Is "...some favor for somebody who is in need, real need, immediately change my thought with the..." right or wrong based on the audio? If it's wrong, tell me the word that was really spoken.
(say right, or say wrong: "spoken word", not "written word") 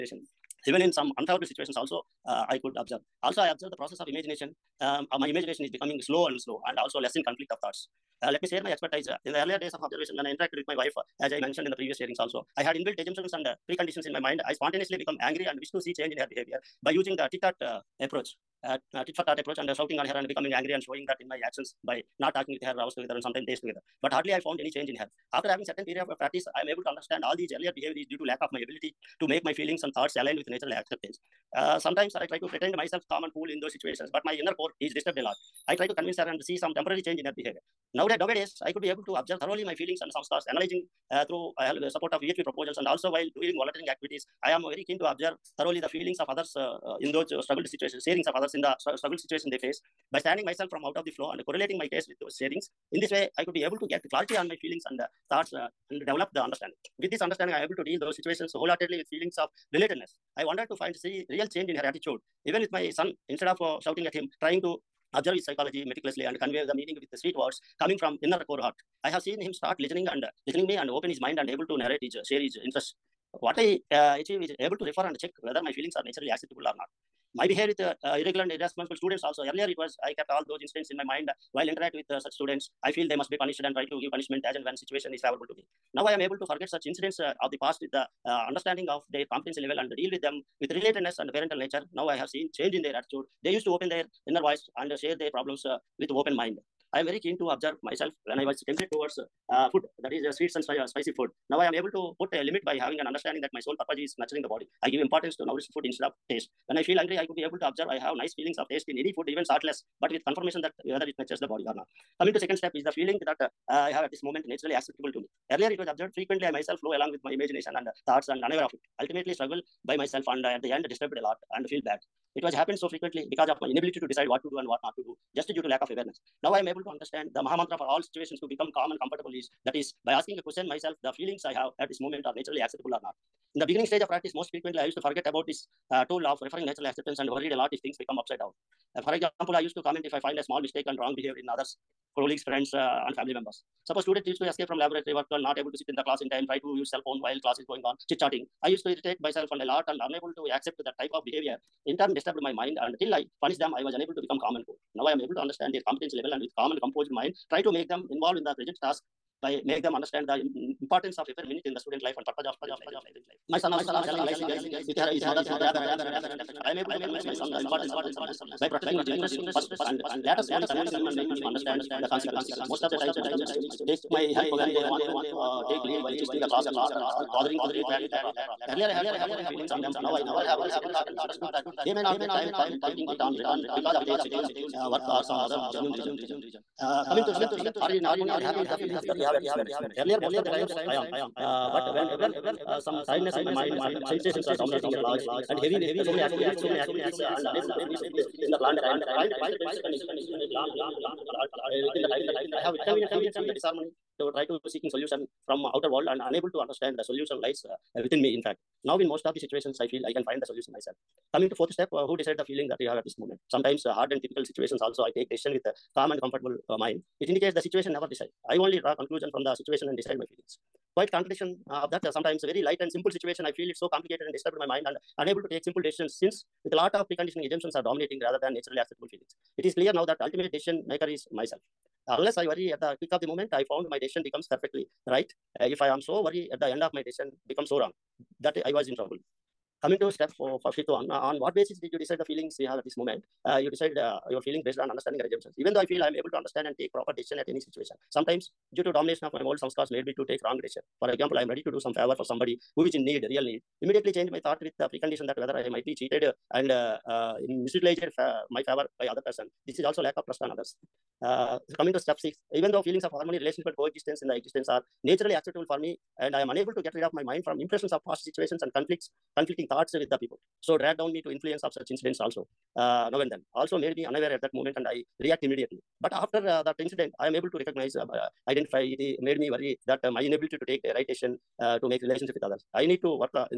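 right.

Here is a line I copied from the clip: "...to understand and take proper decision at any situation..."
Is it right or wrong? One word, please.
right.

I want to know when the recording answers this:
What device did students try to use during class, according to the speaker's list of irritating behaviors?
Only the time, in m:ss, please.
2:26.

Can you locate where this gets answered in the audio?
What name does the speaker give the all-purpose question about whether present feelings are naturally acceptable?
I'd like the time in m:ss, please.
2:07.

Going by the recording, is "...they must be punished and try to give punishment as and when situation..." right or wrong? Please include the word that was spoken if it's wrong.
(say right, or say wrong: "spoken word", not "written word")
right.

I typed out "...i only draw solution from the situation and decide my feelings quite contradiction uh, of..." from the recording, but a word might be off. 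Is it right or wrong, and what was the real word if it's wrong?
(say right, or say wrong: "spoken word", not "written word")
wrong: "conclusion", not "solution".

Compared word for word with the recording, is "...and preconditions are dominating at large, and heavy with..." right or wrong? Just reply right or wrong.
wrong.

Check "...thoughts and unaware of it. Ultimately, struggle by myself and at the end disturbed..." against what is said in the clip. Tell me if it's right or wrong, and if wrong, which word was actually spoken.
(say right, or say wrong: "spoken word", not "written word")
right.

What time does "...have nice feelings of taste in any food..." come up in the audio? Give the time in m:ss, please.
1:48.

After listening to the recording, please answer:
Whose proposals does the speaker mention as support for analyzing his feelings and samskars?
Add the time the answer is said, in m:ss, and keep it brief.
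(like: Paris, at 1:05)
VHP, at 0:42.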